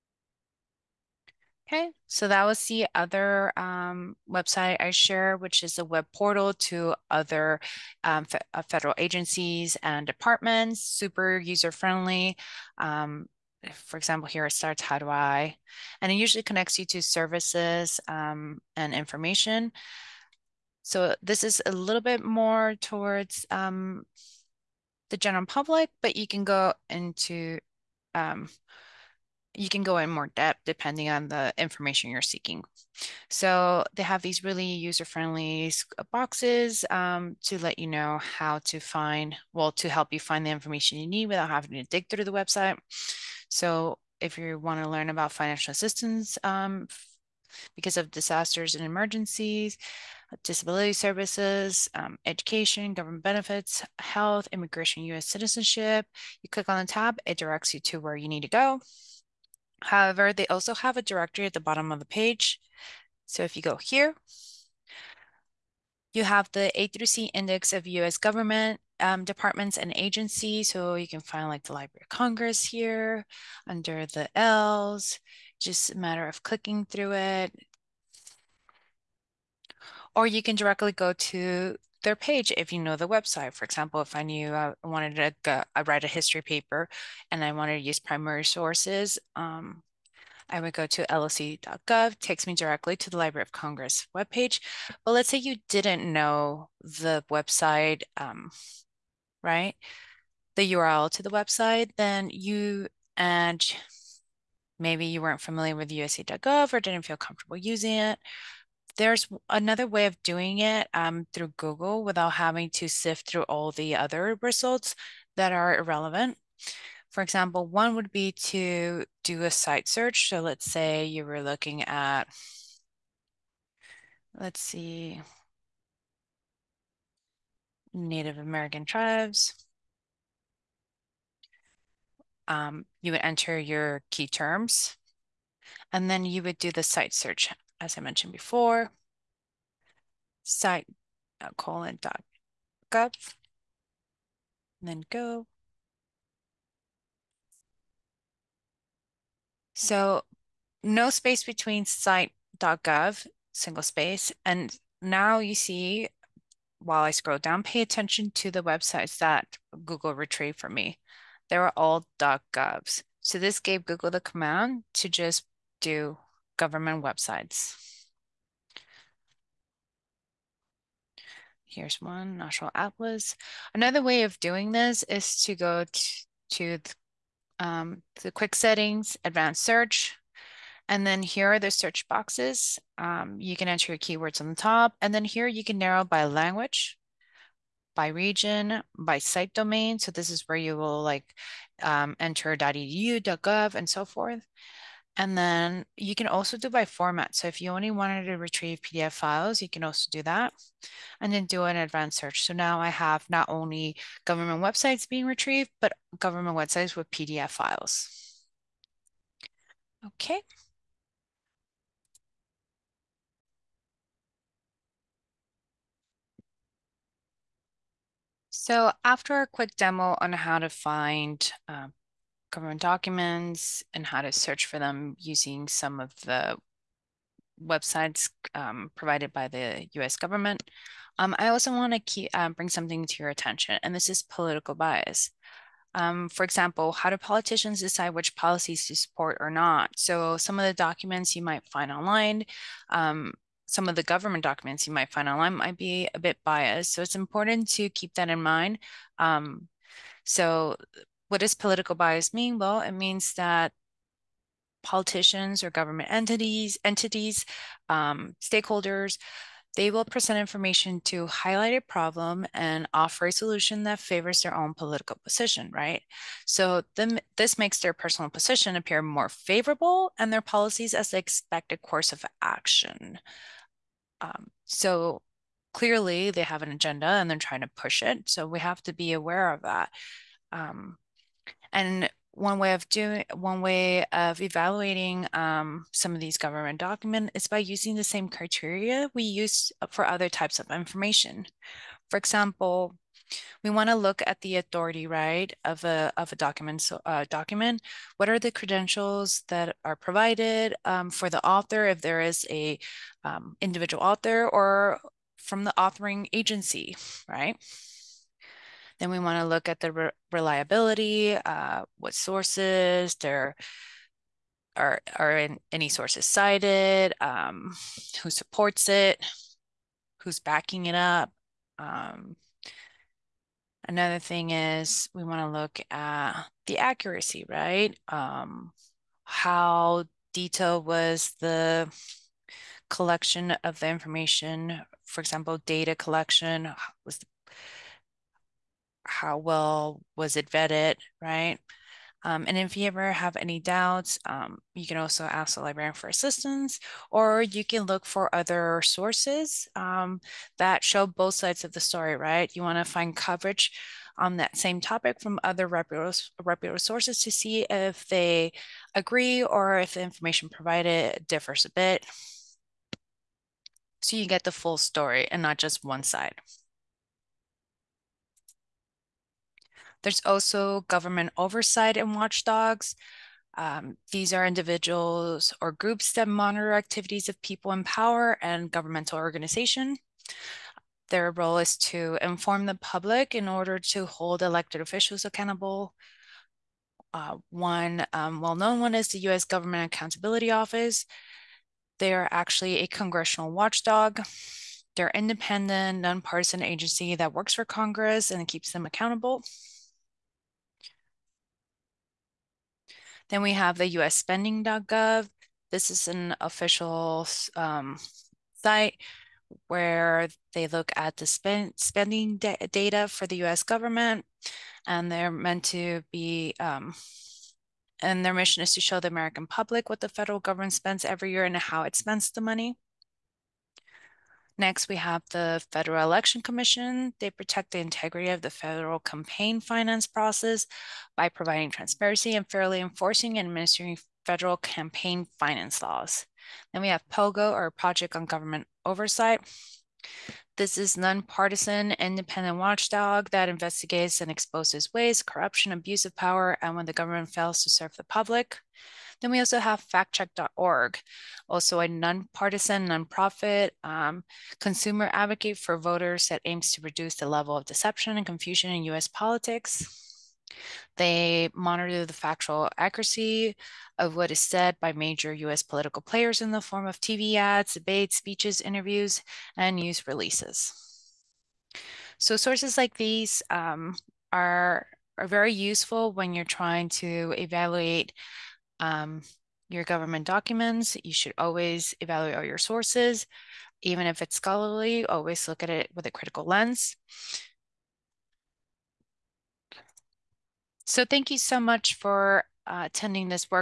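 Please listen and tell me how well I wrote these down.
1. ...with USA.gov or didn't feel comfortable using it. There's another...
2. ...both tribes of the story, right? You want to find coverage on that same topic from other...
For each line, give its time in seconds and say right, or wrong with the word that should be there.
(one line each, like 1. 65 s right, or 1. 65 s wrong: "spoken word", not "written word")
1. 105 s right
2. 351 s wrong: "sides", not "tribes".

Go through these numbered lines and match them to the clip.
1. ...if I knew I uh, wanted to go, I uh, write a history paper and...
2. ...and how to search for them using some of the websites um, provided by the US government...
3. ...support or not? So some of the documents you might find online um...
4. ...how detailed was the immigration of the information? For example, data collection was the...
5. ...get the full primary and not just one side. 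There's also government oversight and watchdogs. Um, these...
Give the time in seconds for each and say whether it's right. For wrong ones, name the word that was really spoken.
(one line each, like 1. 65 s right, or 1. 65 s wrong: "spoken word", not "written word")
1. 83 s right
2. 223 s right
3. 238 s right
4. 329 s wrong: "collection", not "immigration"
5. 364 s wrong: "story", not "primary".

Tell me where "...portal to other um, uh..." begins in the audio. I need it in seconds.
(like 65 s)
6 s.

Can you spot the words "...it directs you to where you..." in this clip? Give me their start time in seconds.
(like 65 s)
57 s.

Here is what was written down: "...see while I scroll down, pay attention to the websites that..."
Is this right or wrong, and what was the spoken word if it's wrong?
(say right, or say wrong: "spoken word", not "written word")
right.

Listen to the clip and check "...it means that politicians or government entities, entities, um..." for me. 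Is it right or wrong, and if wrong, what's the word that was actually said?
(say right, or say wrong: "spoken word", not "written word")
right.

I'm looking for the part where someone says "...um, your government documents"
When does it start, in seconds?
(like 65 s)
478 s.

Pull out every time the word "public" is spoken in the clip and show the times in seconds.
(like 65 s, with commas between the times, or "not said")
25 s, 382 s, 419 s, 448 s.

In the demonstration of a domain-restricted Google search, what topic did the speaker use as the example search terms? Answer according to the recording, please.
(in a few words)
Native American tribes.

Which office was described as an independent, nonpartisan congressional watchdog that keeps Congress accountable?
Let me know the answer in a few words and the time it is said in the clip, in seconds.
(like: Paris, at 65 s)
U.S. Government Accountability Office, at 389 s.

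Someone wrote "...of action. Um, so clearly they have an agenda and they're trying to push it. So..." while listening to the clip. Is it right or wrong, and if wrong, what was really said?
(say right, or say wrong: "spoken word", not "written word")
right.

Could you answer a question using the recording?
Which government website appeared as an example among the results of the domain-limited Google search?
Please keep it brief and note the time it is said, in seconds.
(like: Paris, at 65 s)
National Atlas, at 172 s.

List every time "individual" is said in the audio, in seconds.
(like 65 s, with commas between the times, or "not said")
303 s, 374 s.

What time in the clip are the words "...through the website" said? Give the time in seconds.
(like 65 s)
42 s.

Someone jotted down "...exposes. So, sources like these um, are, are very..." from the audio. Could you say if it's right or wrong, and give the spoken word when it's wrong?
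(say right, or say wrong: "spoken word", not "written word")
wrong: "releases", not "exposes".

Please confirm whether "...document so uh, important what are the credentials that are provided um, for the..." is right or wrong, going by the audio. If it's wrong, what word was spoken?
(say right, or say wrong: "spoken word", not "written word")
wrong: "document", not "important".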